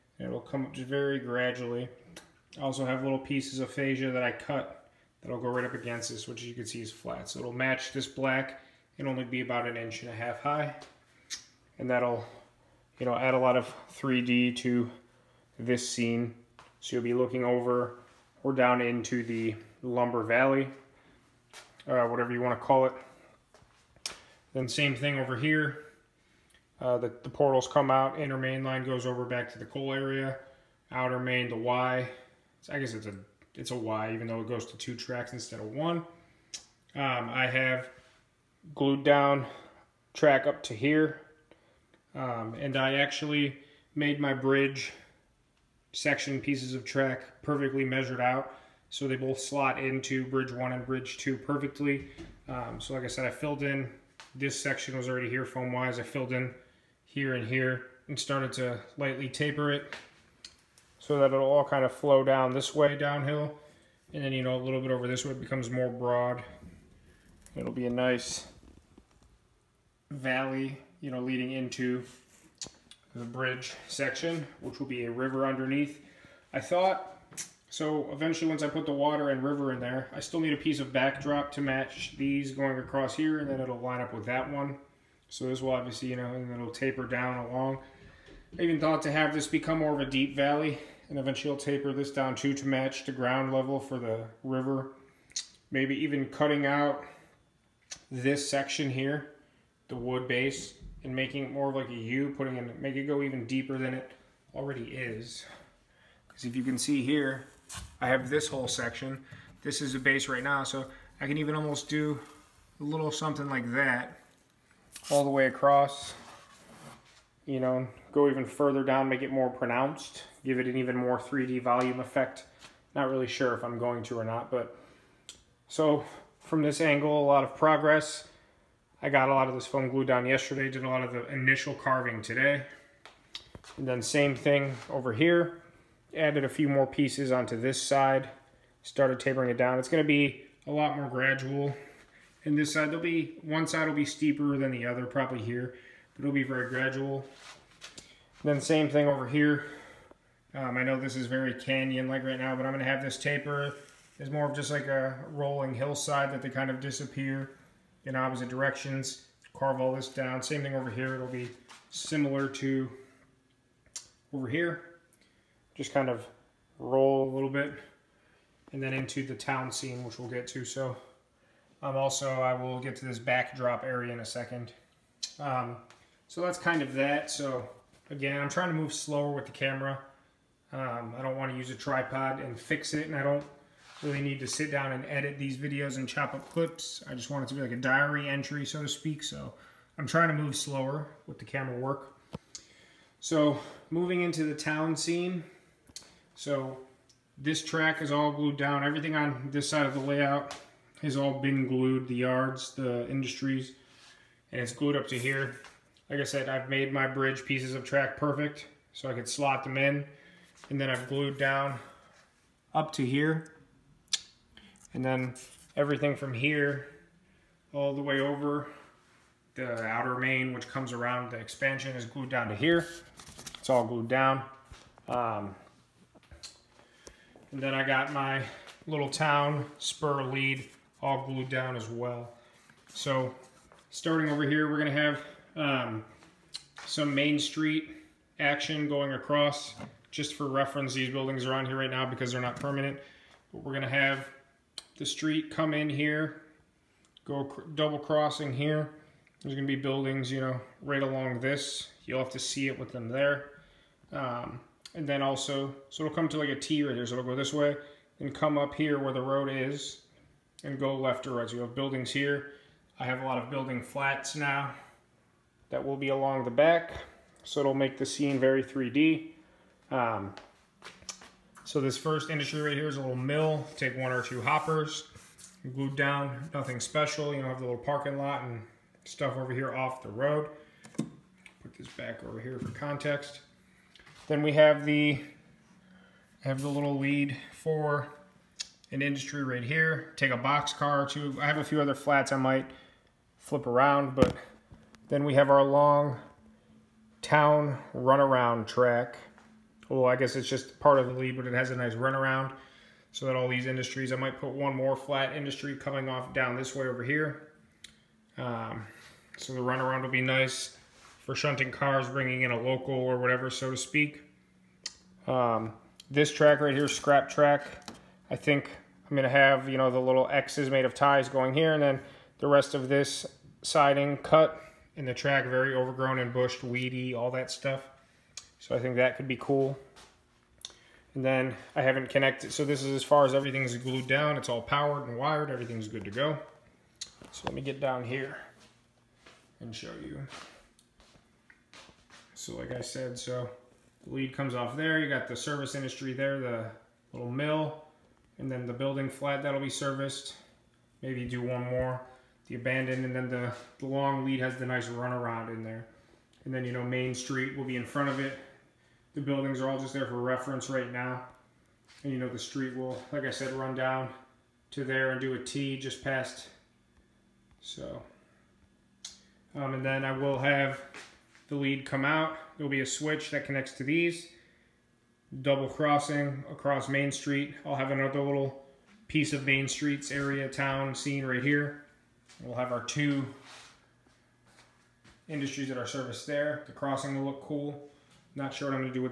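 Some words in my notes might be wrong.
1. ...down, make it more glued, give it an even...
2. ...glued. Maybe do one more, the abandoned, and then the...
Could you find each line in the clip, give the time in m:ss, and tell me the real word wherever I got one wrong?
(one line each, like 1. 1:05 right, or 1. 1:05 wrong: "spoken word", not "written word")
1. 1:58 wrong: "pronounced", not "glued"
2. 5:49 wrong: "serviced", not "glued".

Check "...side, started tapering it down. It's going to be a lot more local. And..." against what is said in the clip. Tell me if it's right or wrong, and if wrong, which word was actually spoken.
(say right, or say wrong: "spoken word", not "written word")
wrong: "gradual", not "local".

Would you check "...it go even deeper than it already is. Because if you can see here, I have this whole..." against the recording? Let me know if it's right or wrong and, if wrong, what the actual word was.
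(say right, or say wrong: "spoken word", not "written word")
right.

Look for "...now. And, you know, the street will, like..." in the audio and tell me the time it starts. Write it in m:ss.
6:00.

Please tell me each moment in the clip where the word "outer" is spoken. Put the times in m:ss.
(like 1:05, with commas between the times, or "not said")
0:30, 3:39.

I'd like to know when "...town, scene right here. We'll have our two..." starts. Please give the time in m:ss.
6:20.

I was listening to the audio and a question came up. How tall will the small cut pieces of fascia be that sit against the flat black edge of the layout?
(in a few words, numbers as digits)
About 1.5 inches.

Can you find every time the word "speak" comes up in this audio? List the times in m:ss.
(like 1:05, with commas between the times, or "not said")
3:08, 5:13.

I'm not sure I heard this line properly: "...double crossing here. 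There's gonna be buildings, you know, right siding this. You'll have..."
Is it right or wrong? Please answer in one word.
wrong.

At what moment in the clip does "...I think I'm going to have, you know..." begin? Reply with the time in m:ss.
5:18.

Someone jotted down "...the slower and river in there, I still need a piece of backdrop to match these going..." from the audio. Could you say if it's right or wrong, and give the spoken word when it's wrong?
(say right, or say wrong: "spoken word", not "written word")
wrong: "water", not "slower".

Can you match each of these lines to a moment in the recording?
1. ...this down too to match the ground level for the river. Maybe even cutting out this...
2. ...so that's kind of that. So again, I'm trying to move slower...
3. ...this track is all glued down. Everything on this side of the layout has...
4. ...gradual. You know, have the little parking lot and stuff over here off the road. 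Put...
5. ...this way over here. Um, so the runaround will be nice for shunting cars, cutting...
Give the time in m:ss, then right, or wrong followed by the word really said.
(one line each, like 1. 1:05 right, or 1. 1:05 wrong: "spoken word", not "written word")
1. 1:31 right
2. 2:56 right
3. 3:17 right
4. 4:36 wrong: "special", not "gradual"
5. 5:06 wrong: "bringing", not "cutting".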